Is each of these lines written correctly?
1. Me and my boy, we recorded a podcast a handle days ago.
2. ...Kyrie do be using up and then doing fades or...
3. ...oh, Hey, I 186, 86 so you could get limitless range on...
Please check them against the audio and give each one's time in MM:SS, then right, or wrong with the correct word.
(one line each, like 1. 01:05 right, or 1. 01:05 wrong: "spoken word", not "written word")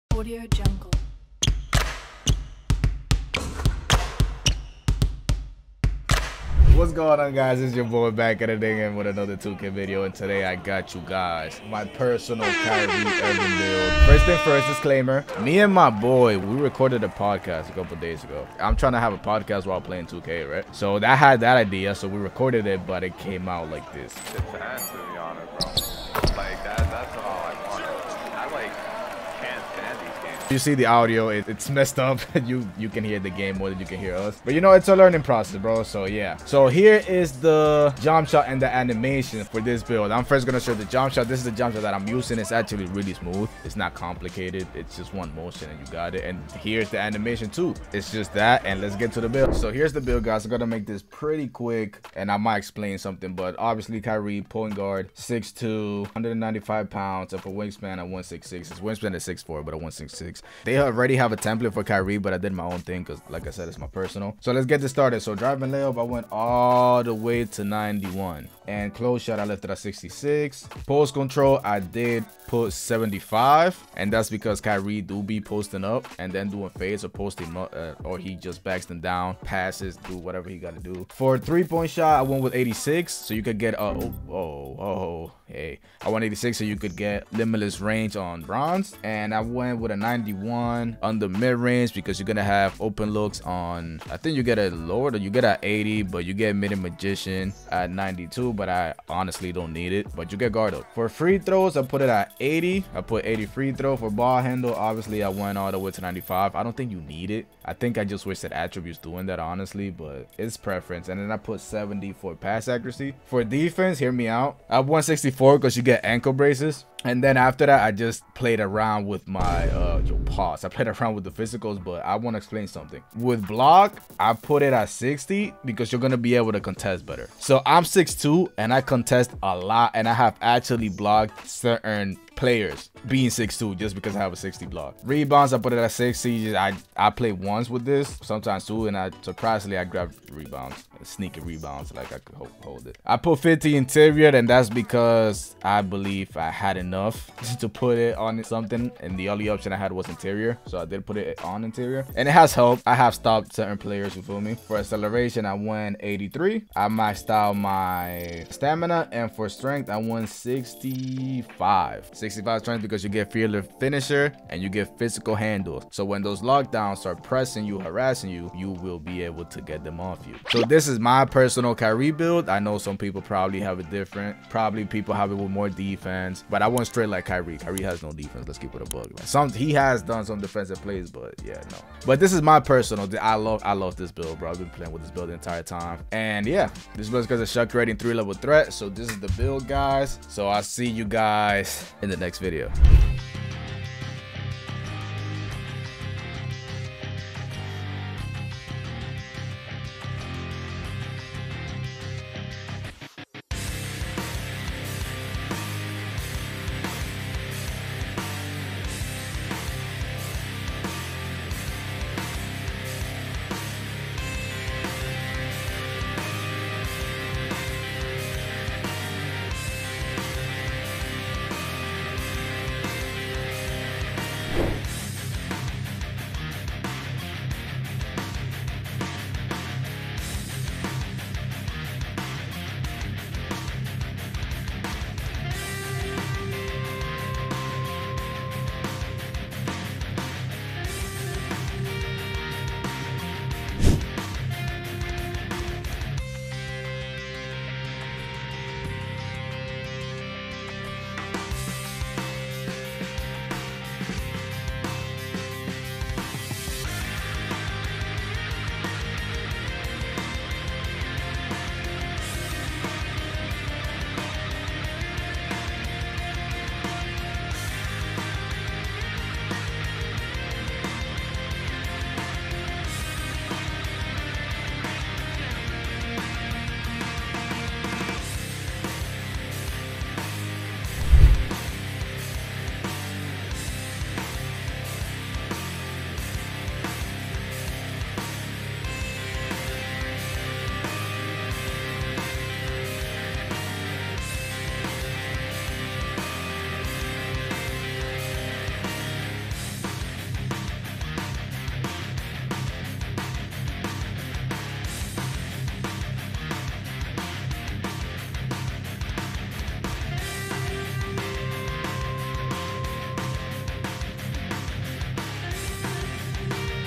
1. 00:15 wrong: "couple", not "handle"
2. 01:14 wrong: "posting", not "using"
3. 01:24 right.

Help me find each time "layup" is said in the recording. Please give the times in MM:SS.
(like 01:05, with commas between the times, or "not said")
01:05.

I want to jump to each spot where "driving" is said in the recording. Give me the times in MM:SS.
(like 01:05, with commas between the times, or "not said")
01:05.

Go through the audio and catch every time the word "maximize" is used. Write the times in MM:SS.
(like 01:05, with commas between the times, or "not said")
not said.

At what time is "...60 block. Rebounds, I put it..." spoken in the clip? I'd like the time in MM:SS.
02:14.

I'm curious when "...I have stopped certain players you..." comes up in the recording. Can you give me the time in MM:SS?
02:32.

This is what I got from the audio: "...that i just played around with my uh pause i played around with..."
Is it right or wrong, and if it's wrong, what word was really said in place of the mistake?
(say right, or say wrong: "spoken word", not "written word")
right.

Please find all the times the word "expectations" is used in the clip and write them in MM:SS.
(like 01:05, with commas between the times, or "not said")
not said.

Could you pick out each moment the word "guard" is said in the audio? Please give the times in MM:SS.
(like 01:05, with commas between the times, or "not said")
00:54, 01:40.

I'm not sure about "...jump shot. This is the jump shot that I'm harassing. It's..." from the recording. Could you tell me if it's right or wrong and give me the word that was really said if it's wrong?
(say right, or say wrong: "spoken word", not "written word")
wrong: "using", not "harassing".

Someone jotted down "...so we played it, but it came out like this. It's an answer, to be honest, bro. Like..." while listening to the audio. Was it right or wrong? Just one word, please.
wrong.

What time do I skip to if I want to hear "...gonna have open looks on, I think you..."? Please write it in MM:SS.
01:32.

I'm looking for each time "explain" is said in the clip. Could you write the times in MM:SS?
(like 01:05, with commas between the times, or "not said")
00:52, 02:02.